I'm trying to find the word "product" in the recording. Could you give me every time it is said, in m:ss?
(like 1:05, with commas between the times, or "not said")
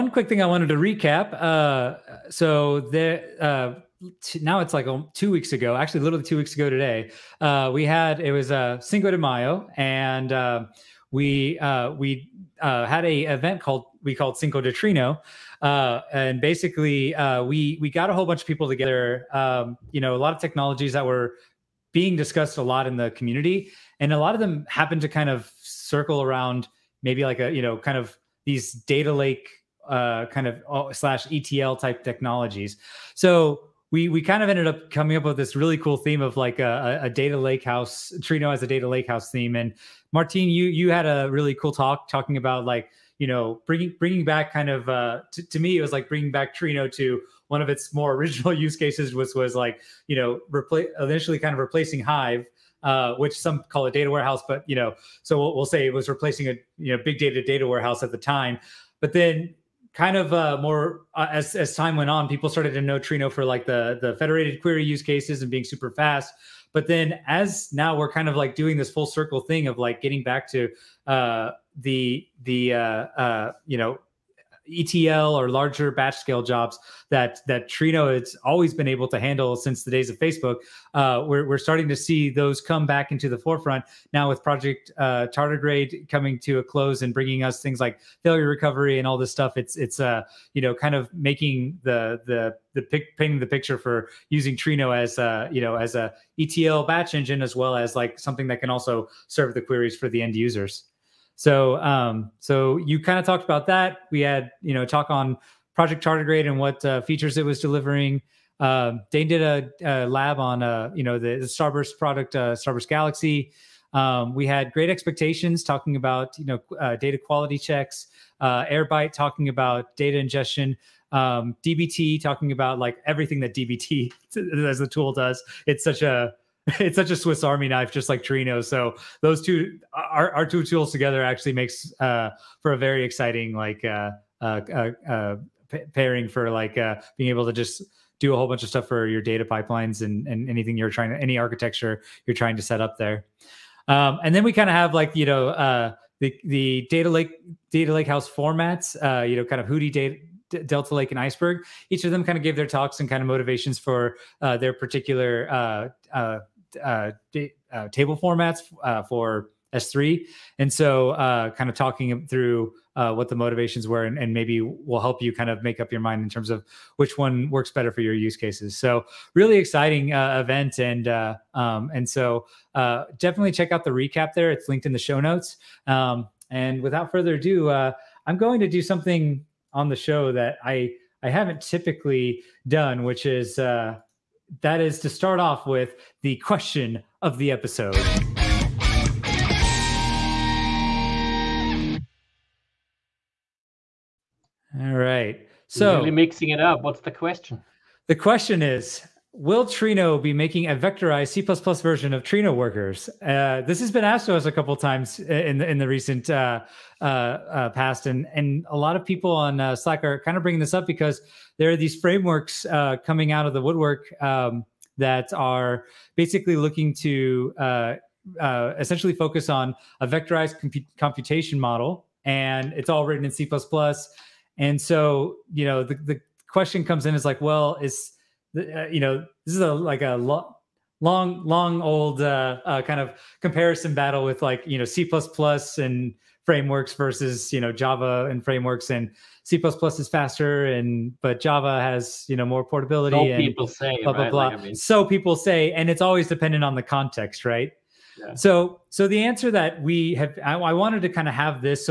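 1:51.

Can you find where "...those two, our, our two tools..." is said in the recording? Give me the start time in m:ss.
2:09.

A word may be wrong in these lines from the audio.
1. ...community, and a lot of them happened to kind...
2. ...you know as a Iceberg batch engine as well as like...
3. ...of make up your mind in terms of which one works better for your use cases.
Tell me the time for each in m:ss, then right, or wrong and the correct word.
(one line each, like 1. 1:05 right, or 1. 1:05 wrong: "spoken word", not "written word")
1. 0:23 right
2. 1:35 wrong: "ETL", not "Iceberg"
3. 2:45 right.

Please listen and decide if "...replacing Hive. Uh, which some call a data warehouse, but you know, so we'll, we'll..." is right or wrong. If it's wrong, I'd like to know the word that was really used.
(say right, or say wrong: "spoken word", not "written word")
right.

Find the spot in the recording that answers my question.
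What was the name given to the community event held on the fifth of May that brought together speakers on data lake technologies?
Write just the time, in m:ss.
0:14.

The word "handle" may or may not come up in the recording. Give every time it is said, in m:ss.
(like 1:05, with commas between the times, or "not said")
1:19.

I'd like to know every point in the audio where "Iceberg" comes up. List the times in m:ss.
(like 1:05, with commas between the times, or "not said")
2:31.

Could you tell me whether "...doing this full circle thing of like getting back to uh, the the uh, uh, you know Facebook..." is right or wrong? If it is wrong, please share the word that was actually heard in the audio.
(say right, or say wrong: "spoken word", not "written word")
wrong: "ETL", not "Facebook".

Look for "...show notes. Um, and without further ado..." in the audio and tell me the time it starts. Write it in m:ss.
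2:54.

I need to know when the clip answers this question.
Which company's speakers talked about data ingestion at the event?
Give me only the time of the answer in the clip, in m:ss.
1:58.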